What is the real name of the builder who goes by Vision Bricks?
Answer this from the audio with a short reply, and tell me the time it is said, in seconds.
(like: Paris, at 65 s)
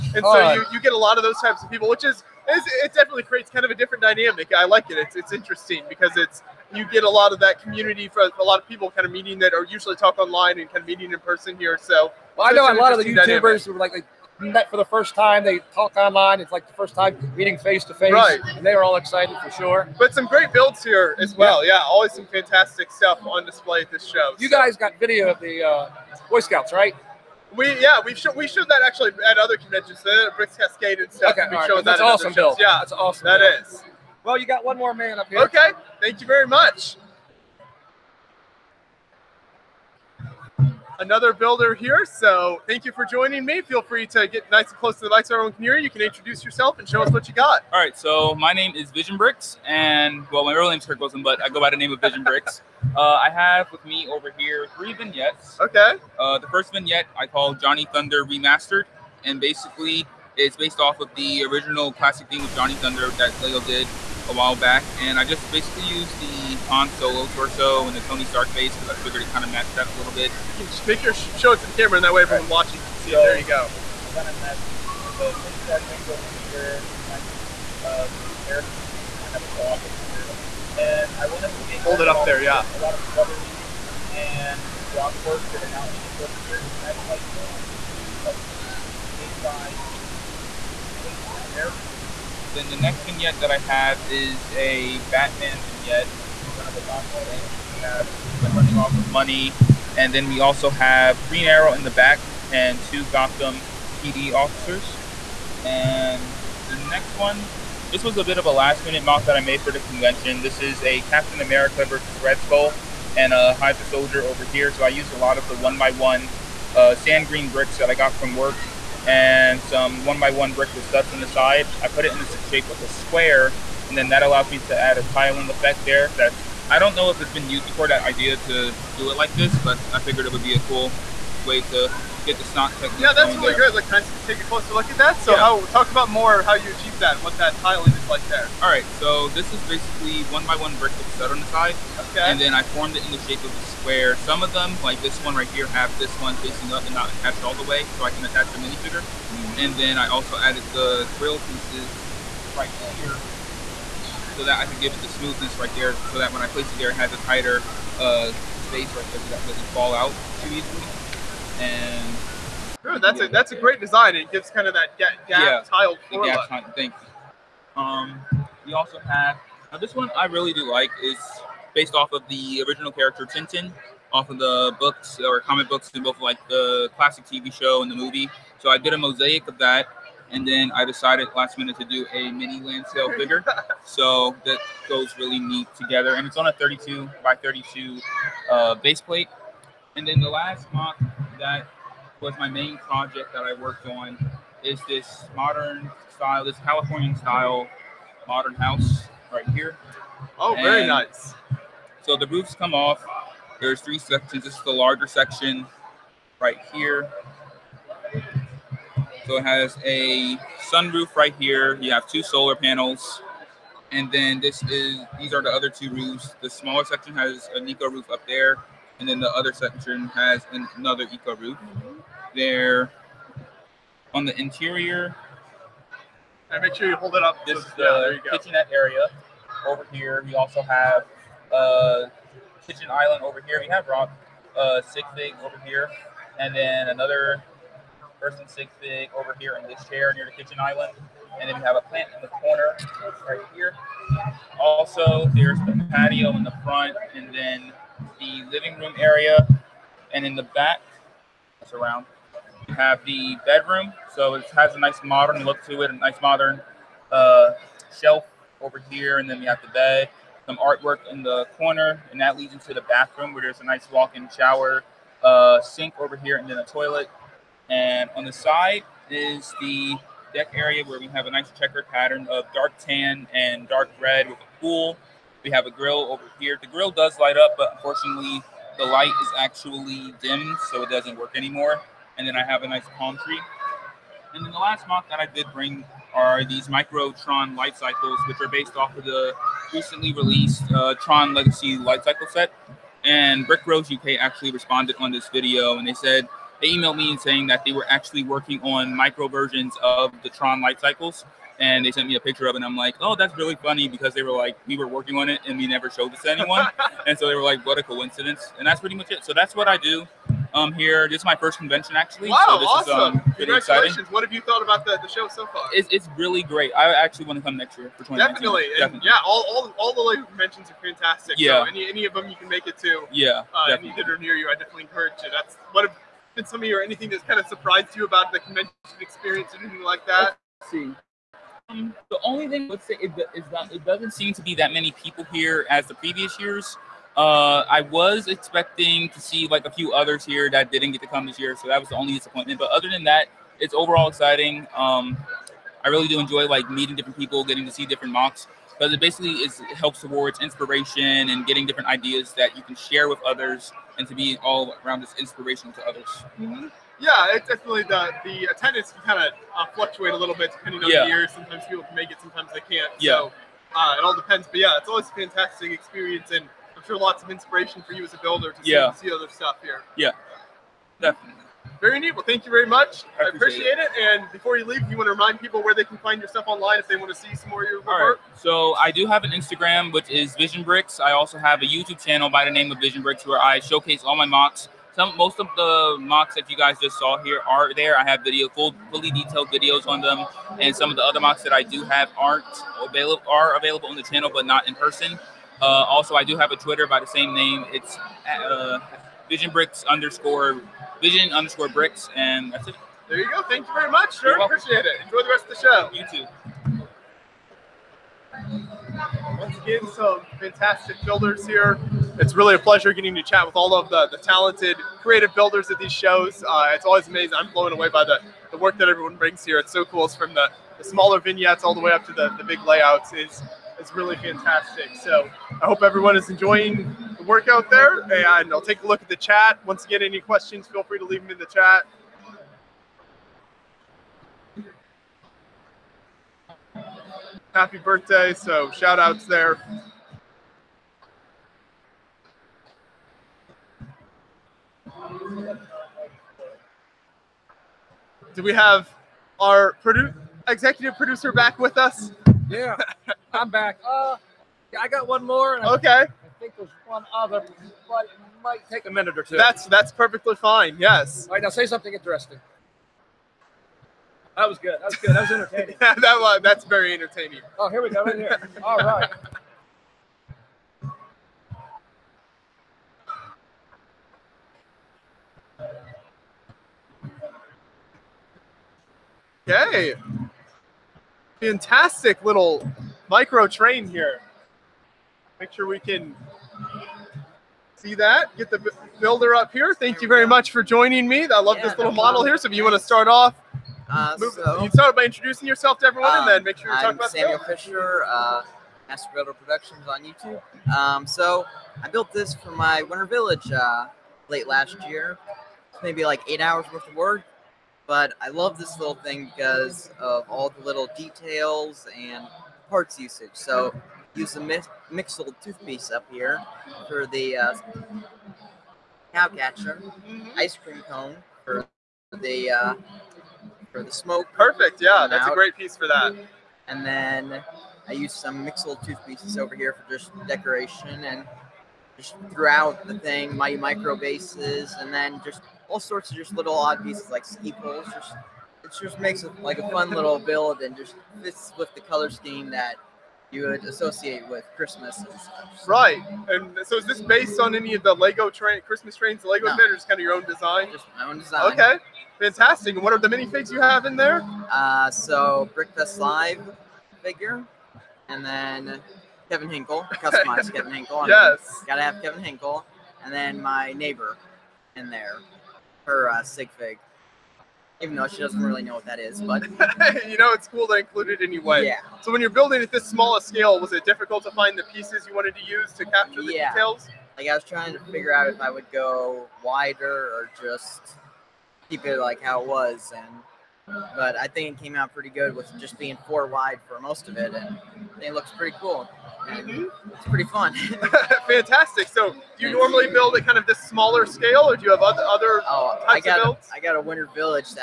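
Kirk Wilson, at 50 s.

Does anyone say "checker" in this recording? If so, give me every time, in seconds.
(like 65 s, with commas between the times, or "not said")
271 s.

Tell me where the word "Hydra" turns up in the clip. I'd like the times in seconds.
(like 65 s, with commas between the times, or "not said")
113 s.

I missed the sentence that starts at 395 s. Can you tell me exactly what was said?
Uh, also, I do have a Twitter by the same name.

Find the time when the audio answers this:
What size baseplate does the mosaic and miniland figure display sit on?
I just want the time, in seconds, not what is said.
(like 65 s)
186 s.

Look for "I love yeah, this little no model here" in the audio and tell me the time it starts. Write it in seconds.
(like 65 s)
491 s.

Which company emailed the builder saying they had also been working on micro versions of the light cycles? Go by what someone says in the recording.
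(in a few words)
Brick Rose UK.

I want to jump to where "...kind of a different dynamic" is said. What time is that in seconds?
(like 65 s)
3 s.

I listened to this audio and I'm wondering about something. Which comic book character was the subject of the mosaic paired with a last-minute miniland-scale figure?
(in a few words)
Tintin.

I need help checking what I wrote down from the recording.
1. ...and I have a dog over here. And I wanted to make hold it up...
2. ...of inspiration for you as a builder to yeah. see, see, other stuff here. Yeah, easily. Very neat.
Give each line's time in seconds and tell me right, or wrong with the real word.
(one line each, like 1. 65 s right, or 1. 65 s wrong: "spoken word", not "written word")
1. 79 s right
2. 367 s wrong: "definitely", not "easily".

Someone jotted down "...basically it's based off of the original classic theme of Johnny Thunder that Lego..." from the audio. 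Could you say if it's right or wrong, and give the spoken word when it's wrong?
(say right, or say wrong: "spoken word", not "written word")
right.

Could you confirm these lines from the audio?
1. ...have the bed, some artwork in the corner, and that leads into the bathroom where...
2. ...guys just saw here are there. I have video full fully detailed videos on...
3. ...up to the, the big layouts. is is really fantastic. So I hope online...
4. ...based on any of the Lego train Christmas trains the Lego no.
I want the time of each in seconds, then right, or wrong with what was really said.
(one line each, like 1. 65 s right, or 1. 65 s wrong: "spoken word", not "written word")
1. 259 s right
2. 386 s right
3. 421 s wrong: "everyone", not "online"
4. 547 s right.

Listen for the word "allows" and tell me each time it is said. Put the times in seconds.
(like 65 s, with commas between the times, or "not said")
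124 s.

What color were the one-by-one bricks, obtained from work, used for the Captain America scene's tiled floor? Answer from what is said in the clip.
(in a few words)
sand green.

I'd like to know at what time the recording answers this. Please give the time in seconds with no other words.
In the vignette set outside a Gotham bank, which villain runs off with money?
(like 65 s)
98 s.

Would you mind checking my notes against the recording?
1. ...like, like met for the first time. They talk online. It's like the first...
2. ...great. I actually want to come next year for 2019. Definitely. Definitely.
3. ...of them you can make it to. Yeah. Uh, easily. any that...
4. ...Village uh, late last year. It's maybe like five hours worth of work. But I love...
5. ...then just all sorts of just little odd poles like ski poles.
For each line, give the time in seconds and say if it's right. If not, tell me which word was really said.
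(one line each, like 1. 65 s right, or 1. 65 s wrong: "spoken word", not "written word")
1. 13 s right
2. 316 s right
3. 322 s wrong: "definitely", not "easily"
4. 503 s wrong: "eight", not "five"
5. 534 s wrong: "pieces", not "poles".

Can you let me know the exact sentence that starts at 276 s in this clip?
The grill does light up, but unfortunately, the light is actually dim, so it doesn't work anymore.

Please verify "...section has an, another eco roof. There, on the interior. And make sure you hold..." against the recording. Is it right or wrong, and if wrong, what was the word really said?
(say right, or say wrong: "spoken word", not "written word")
right.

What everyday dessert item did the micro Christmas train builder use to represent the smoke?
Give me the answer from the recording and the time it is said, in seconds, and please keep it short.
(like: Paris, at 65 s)
ice cream cone, at 520 s.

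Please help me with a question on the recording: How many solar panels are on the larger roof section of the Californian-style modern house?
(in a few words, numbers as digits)
2.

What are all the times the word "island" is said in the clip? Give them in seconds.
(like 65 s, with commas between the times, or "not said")
232 s, 240 s.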